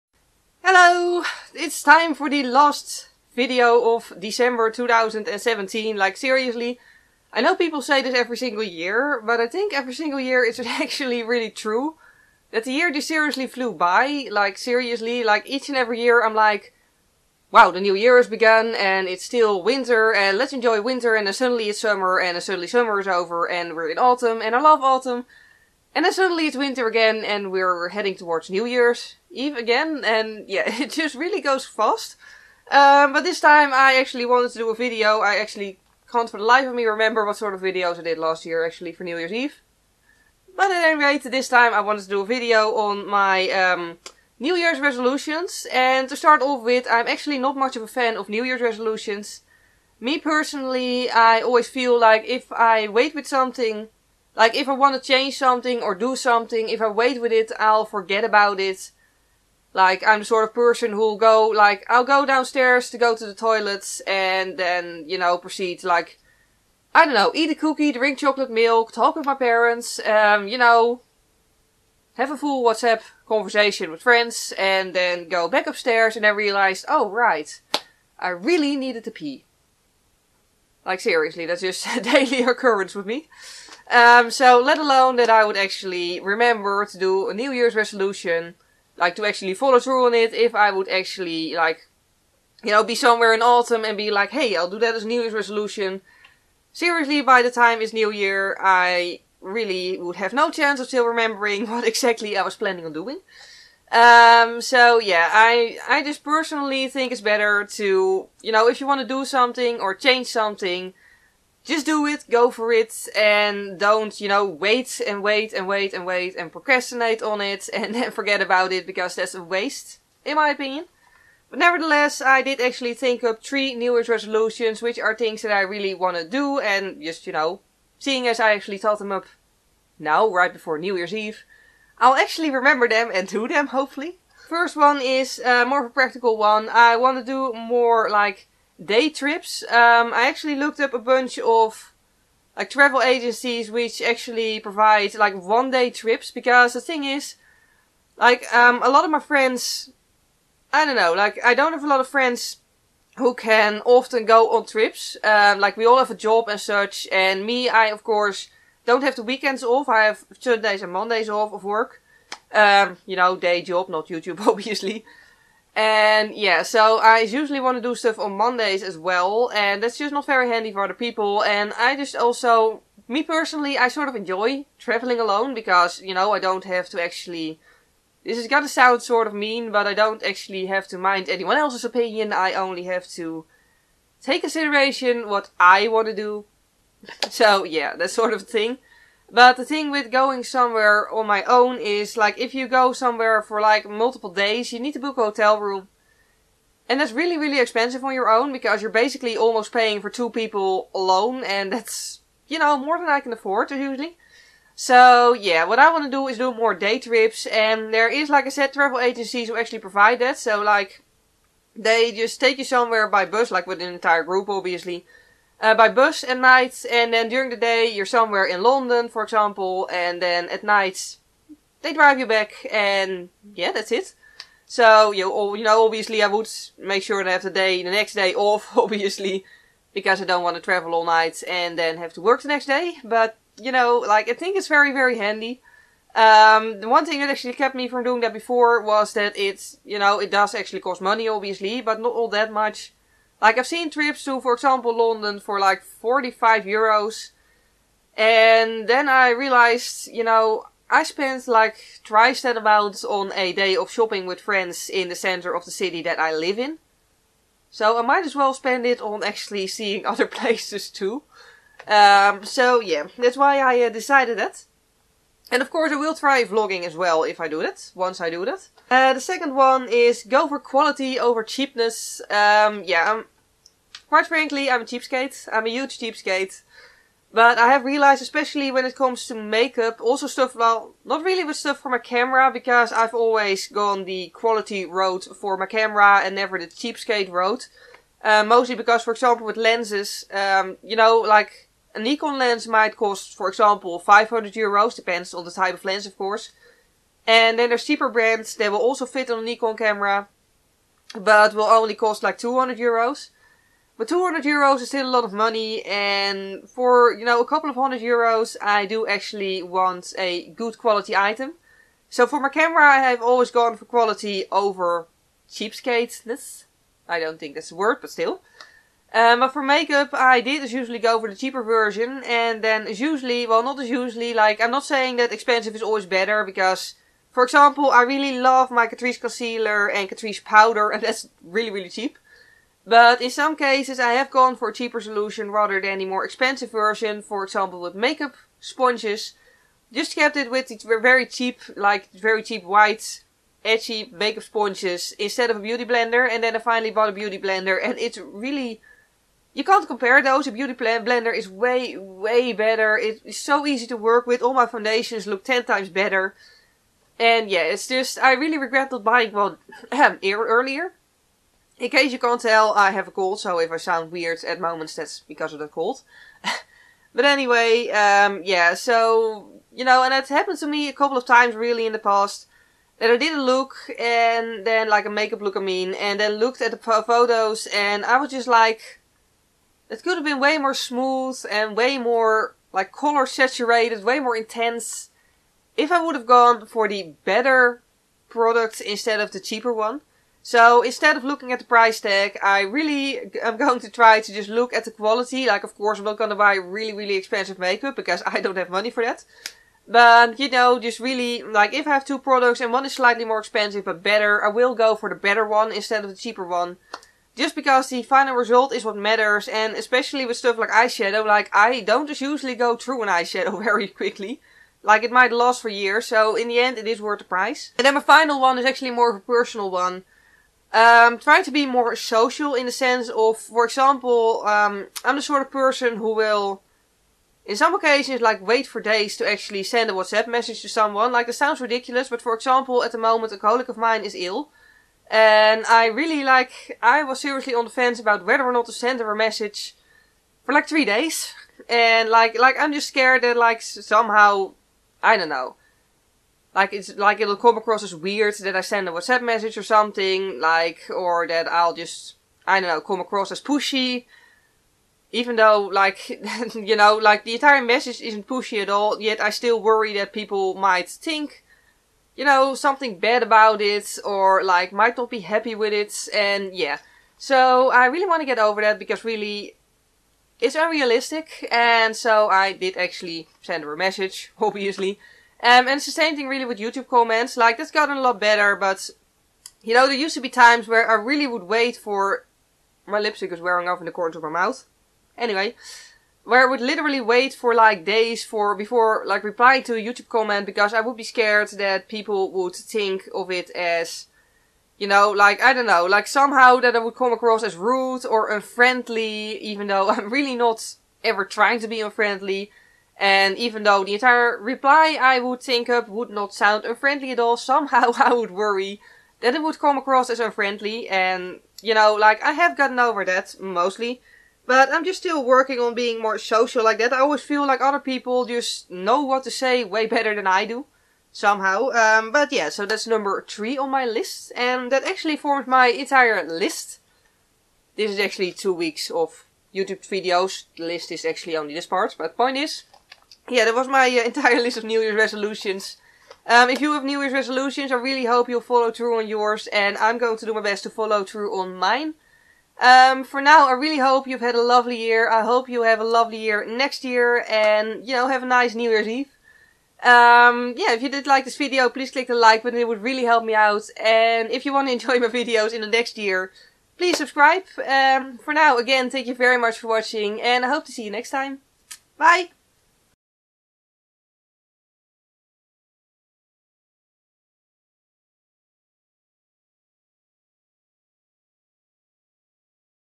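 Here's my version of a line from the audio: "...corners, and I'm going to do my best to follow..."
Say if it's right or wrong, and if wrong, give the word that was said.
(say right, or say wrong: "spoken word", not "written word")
wrong: "yours", not "corners".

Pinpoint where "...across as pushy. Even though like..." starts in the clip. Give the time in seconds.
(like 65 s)
452 s.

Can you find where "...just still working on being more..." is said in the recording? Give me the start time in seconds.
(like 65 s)
514 s.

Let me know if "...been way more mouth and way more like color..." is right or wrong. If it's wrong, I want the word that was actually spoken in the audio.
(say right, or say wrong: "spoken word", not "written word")
wrong: "smooth", not "mouth".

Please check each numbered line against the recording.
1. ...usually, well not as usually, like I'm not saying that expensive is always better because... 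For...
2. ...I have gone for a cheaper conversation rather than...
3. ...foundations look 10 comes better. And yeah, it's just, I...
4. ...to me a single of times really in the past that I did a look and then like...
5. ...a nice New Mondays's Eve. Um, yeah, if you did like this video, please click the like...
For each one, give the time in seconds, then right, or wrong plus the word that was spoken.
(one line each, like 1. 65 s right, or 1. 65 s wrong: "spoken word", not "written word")
1. 322 s right
2. 333 s wrong: "solution", not "conversation"
3. 354 s wrong: "times", not "comes"
4. 370 s wrong: "couple", not "single"
5. 548 s wrong: "Year", not "Mondays".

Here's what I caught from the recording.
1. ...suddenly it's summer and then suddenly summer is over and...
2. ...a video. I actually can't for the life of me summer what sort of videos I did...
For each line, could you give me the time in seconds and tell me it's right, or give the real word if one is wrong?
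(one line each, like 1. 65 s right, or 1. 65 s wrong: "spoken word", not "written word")
1. 21 s right
2. 34 s wrong: "remember", not "summer".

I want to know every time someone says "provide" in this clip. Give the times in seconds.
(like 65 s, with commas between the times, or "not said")
144 s, 209 s.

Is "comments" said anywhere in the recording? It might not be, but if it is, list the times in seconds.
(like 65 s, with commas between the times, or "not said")
476 s, 490 s.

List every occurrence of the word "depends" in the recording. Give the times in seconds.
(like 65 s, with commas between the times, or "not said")
294 s.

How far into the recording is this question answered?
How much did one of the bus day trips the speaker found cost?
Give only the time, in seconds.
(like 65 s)
245 s.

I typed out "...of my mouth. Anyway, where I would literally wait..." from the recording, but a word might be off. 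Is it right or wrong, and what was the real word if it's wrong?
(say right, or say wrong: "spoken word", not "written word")
right.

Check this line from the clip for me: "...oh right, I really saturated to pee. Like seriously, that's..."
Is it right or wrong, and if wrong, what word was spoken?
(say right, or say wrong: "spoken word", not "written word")
wrong: "needed", not "saturated".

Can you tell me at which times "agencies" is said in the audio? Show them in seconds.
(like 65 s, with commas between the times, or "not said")
143 s, 208 s.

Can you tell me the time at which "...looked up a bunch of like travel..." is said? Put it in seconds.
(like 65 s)
140 s.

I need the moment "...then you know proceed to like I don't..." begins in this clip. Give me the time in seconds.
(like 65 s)
64 s.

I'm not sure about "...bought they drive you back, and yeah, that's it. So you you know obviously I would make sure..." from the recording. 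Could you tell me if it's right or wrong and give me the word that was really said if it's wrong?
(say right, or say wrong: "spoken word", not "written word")
wrong: "night", not "bought".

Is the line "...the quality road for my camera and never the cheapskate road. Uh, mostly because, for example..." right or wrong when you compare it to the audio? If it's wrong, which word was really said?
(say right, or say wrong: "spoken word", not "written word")
right.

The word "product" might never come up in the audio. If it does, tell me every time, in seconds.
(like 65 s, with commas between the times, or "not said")
388 s, 402 s.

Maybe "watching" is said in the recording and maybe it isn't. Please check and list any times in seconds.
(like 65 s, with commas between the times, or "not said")
559 s.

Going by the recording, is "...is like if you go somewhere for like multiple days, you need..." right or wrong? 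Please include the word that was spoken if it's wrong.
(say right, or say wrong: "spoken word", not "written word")
right.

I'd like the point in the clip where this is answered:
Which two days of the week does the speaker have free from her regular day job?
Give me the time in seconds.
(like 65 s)
160 s.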